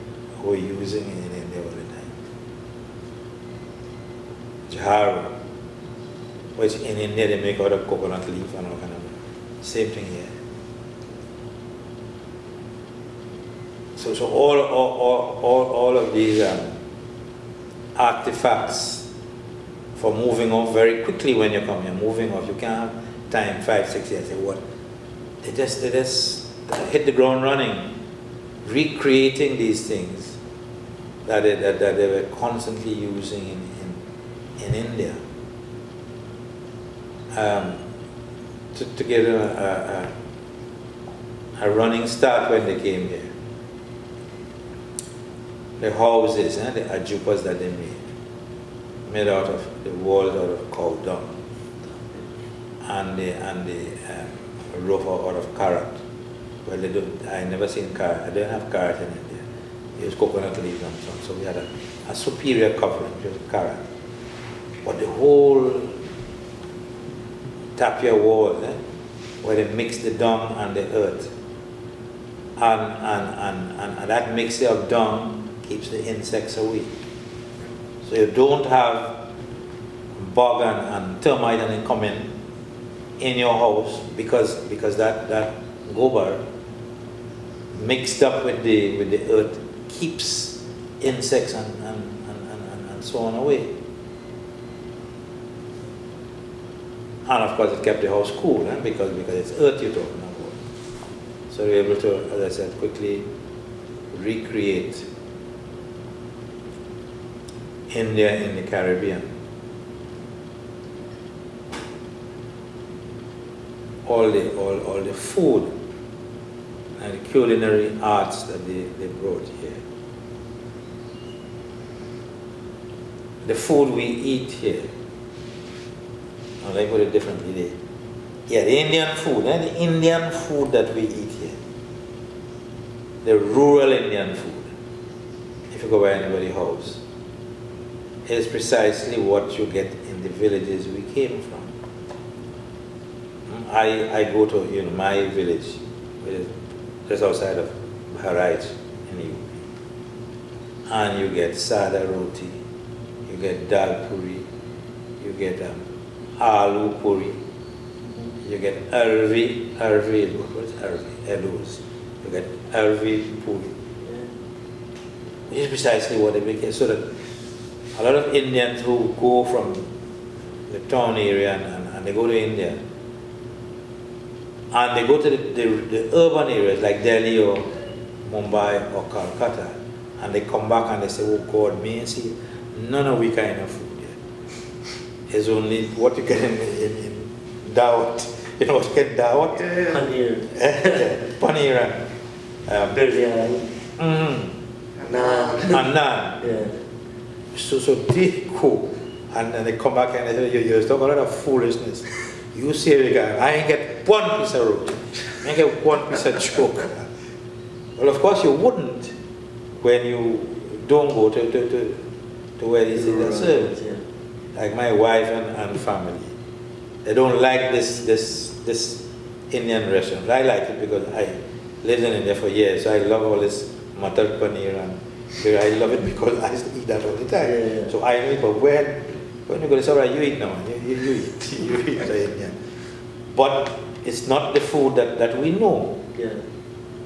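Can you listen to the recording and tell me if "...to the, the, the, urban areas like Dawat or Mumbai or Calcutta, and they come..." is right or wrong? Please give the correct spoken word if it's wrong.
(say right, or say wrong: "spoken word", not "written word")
wrong: "Delhi", not "Dawat".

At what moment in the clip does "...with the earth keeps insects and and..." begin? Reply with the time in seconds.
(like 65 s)
88 s.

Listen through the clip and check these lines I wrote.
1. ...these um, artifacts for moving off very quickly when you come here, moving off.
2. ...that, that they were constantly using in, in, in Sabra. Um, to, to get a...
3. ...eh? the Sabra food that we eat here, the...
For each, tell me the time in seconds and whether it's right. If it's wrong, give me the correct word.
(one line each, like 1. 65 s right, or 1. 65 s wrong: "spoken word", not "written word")
1. 16 s right
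2. 31 s wrong: "India", not "Sabra"
3. 129 s wrong: "Indian", not "Sabra".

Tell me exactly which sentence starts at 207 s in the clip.
Well, of course you wouldn't when you don't go to, to, to, to where is it that service.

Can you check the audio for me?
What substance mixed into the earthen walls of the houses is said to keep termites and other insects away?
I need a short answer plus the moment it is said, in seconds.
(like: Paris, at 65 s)
Gobar, at 85 s.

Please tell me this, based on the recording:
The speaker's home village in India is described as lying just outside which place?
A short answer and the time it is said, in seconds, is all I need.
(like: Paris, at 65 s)
Bharaj, at 148 s.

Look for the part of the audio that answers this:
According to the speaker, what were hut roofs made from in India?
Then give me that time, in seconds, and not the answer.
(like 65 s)
60 s.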